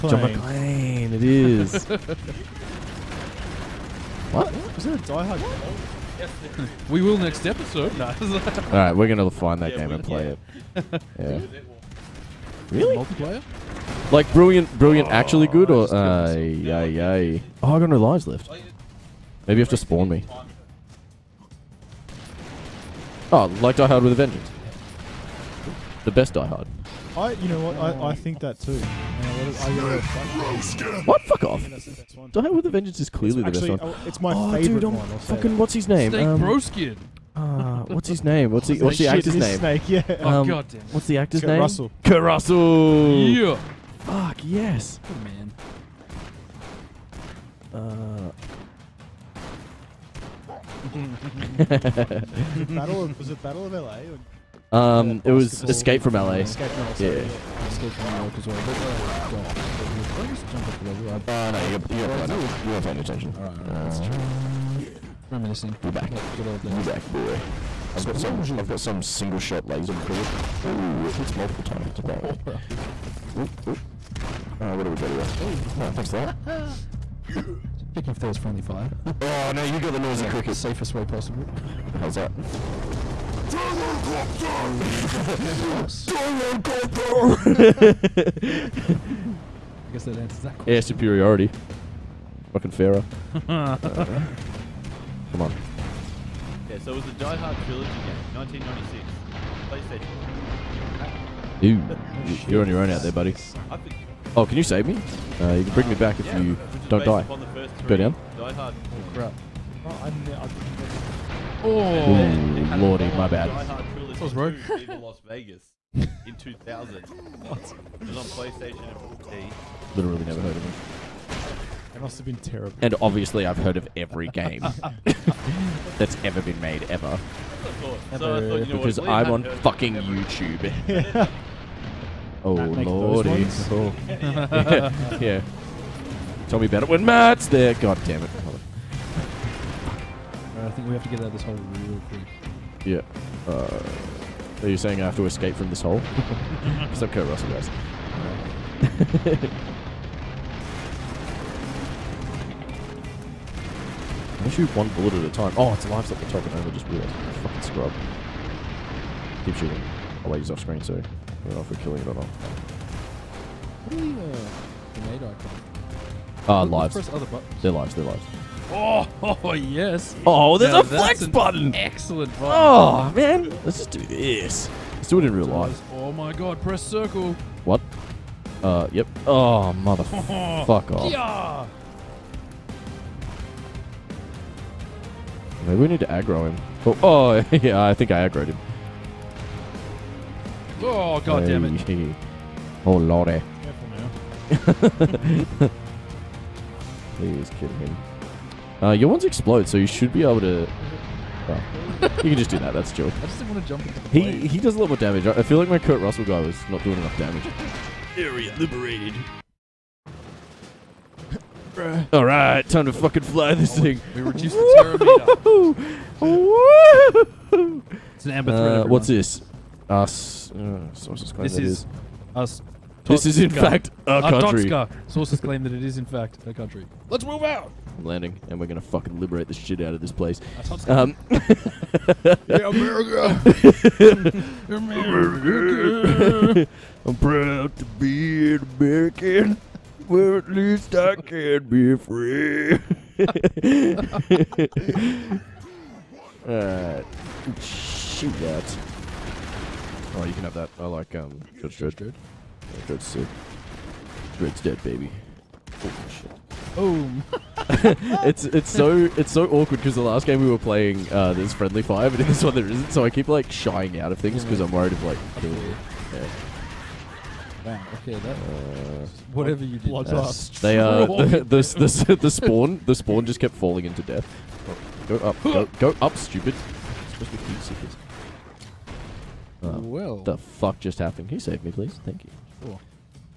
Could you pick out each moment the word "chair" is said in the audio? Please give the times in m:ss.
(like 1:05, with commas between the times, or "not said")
not said.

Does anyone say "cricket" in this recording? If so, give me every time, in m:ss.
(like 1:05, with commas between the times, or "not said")
1:20.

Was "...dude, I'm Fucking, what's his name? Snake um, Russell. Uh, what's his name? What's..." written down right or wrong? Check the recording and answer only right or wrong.
wrong.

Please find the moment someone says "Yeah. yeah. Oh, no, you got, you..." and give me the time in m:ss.
0:56.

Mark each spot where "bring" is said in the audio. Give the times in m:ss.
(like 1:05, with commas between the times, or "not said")
1:45.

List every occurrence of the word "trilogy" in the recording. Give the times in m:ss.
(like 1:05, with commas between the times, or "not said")
1:37.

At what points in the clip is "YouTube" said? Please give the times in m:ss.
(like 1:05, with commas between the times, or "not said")
2:09.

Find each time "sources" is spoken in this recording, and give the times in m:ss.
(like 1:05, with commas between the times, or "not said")
3:40, 3:45.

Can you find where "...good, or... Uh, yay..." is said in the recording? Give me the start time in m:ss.
0:15.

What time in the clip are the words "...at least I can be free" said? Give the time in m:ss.
4:00.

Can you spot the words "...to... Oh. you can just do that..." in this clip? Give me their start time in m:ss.
3:20.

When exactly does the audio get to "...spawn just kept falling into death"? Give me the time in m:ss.
4:32.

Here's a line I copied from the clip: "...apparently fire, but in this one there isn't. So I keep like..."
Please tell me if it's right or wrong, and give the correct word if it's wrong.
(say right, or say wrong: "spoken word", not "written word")
wrong: "friendly", not "apparently".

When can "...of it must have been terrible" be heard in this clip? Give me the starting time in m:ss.
2:00.